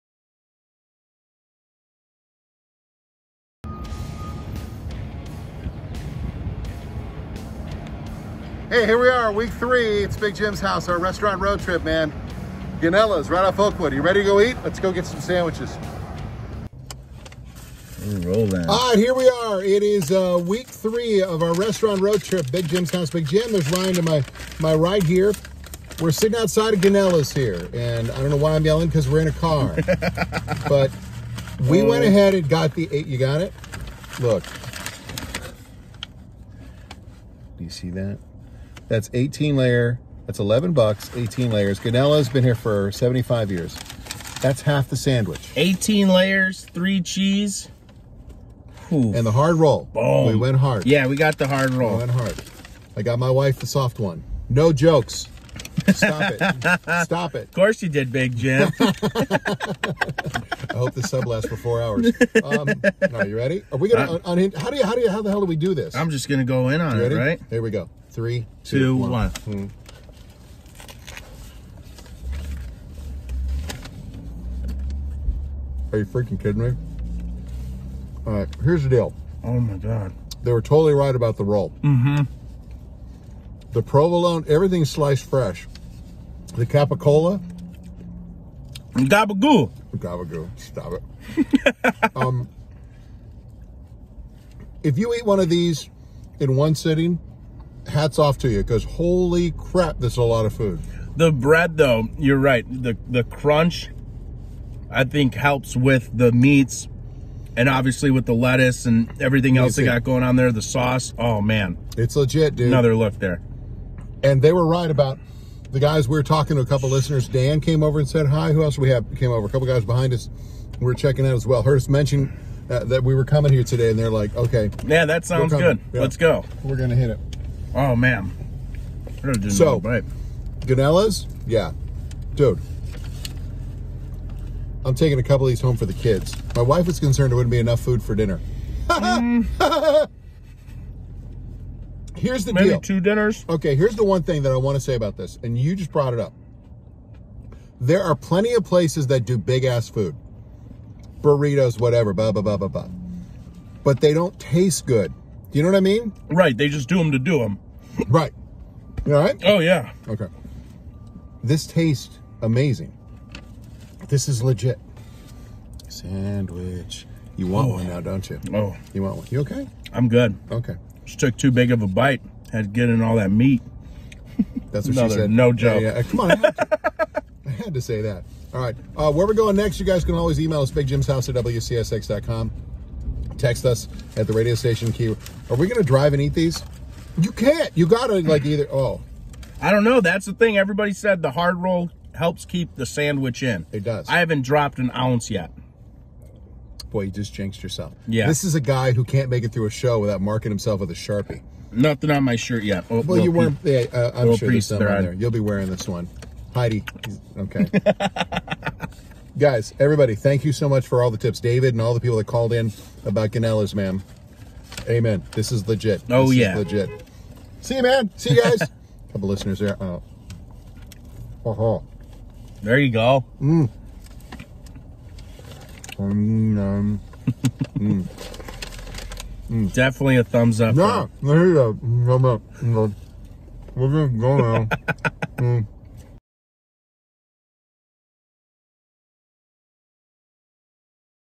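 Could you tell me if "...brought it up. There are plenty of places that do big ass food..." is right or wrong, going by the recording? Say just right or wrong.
right.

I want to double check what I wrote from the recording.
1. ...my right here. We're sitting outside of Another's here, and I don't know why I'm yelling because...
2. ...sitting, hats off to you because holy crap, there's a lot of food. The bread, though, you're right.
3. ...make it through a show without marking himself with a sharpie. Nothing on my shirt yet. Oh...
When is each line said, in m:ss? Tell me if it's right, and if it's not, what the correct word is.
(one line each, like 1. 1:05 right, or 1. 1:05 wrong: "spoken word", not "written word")
1. 0:24 wrong: "Gonella", not "Another"
2. 1:36 right
3. 3:19 right.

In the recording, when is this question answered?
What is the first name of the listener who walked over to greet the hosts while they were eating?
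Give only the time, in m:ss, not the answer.
1:57.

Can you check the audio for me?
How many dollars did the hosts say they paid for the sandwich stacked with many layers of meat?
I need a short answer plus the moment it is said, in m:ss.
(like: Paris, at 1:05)
11, at 0:40.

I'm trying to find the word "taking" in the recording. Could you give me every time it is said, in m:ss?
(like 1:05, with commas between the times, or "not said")
2:14.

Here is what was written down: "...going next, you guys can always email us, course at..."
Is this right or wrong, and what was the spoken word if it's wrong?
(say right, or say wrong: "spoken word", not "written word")
wrong: "bigjimshouse", not "course".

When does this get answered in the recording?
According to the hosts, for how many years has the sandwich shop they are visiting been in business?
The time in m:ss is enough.
0:42.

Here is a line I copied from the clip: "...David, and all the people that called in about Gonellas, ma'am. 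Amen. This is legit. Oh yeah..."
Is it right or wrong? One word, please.
right.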